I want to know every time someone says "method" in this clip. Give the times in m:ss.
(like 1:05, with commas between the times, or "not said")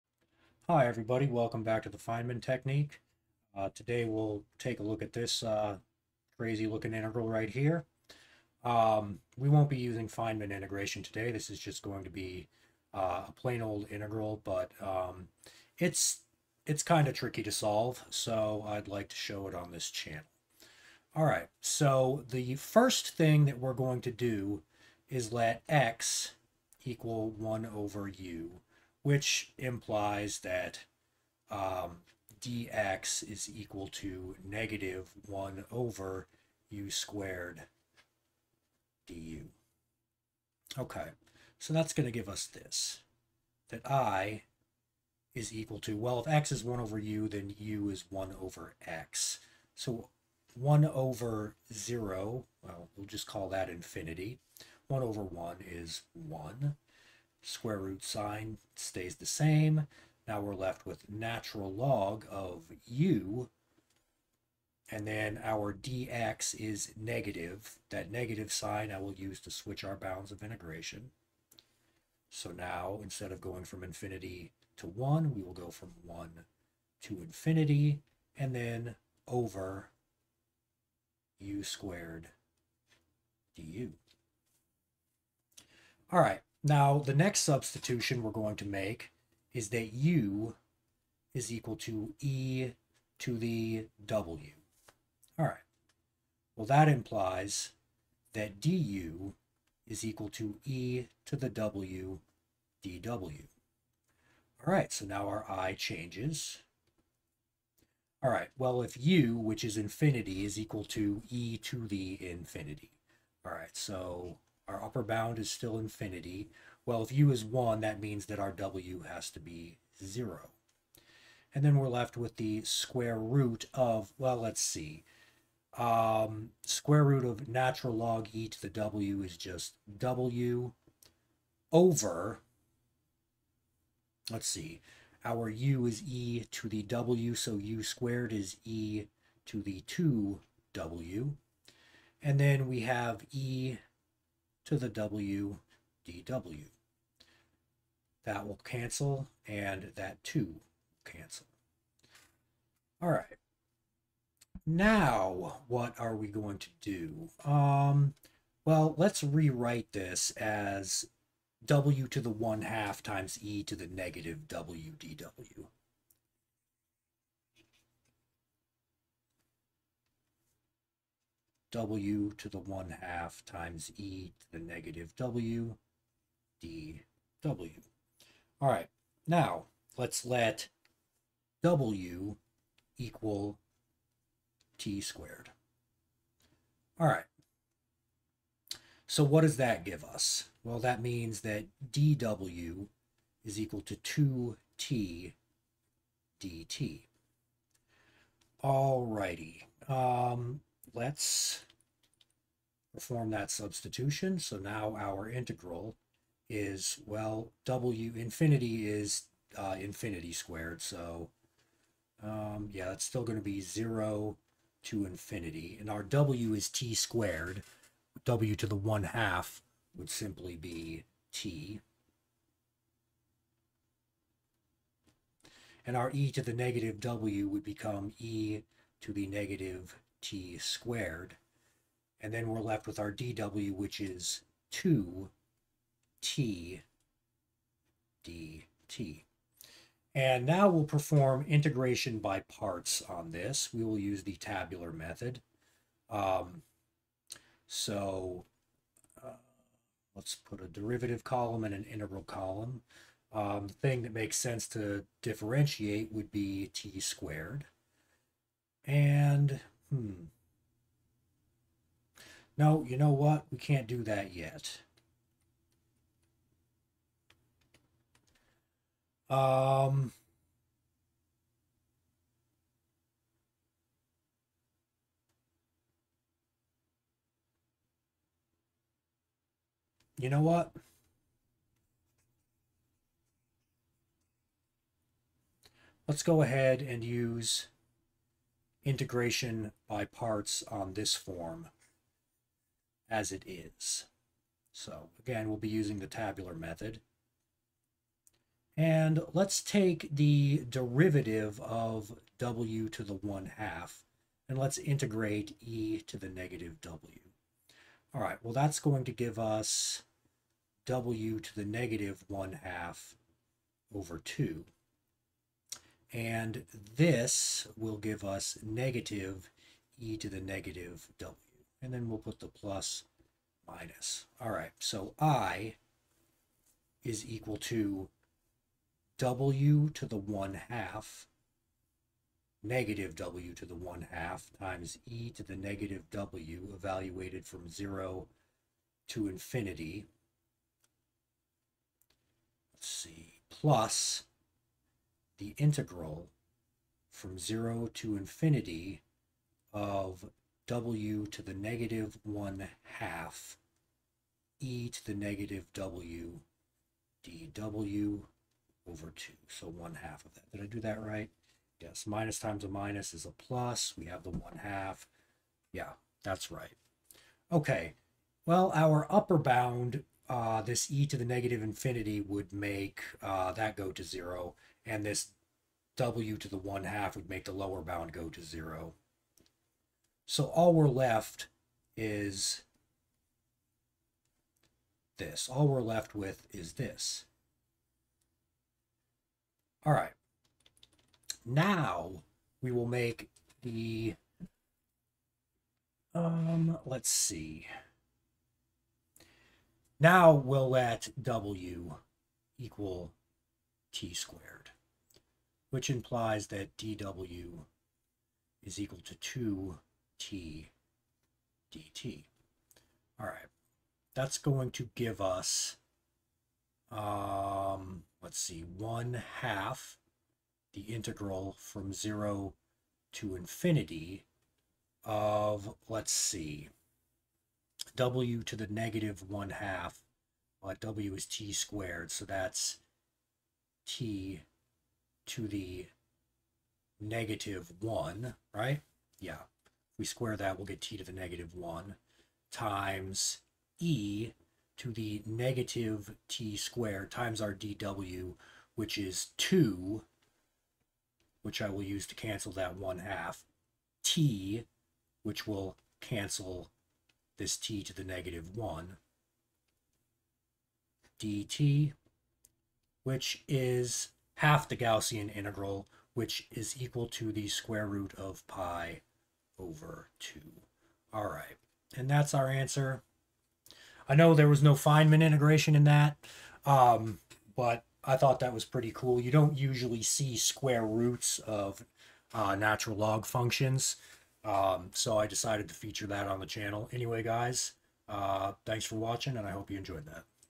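4:04, 4:56.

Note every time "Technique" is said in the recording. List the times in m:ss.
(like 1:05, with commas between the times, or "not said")
0:02.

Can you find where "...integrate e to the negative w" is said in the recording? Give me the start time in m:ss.
5:04.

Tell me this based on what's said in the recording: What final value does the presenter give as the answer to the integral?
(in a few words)
square root of pi over 2.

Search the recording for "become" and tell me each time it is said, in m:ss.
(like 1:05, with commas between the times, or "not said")
3:47.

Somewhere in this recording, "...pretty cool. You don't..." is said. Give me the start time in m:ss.
7:58.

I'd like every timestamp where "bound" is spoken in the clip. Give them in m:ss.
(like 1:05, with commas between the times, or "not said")
1:09, 1:55, 6:09, 6:17.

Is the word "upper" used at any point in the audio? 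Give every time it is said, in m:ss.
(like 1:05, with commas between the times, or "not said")
1:54, 6:09.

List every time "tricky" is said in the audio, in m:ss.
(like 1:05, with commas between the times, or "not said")
0:17.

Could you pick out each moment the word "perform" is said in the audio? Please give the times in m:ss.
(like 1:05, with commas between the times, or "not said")
3:22, 4:00.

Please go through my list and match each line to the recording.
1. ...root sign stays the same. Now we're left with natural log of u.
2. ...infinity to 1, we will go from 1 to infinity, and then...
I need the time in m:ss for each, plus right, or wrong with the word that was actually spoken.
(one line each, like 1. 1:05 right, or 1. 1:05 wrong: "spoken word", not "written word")
1. 0:57 right
2. 1:13 right.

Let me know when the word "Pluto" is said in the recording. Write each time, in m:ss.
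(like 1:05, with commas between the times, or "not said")
not said.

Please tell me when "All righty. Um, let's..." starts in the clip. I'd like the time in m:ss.
3:18.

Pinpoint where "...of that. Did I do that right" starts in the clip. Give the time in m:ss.
6:00.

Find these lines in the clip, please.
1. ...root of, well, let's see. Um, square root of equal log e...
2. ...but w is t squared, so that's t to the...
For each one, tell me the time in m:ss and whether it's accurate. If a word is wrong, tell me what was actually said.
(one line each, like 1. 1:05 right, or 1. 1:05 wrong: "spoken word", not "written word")
1. 2:03 wrong: "natural", not "equal"
2. 7:10 right.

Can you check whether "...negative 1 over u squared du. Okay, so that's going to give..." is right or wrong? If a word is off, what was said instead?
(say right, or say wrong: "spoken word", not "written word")
right.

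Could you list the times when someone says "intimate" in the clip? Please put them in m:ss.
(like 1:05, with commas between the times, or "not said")
not said.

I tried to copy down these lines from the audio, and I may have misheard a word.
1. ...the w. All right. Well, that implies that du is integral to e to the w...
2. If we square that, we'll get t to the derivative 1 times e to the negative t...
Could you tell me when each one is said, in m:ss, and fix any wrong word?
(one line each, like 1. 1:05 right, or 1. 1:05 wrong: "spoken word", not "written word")
1. 1:33 wrong: "equal", not "integral"
2. 7:19 wrong: "negative", not "derivative".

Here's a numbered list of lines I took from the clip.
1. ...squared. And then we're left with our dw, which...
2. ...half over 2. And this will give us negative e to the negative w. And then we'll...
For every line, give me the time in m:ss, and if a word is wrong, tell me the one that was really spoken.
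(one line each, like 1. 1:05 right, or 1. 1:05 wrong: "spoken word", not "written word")
1. 3:50 right
2. 5:12 right.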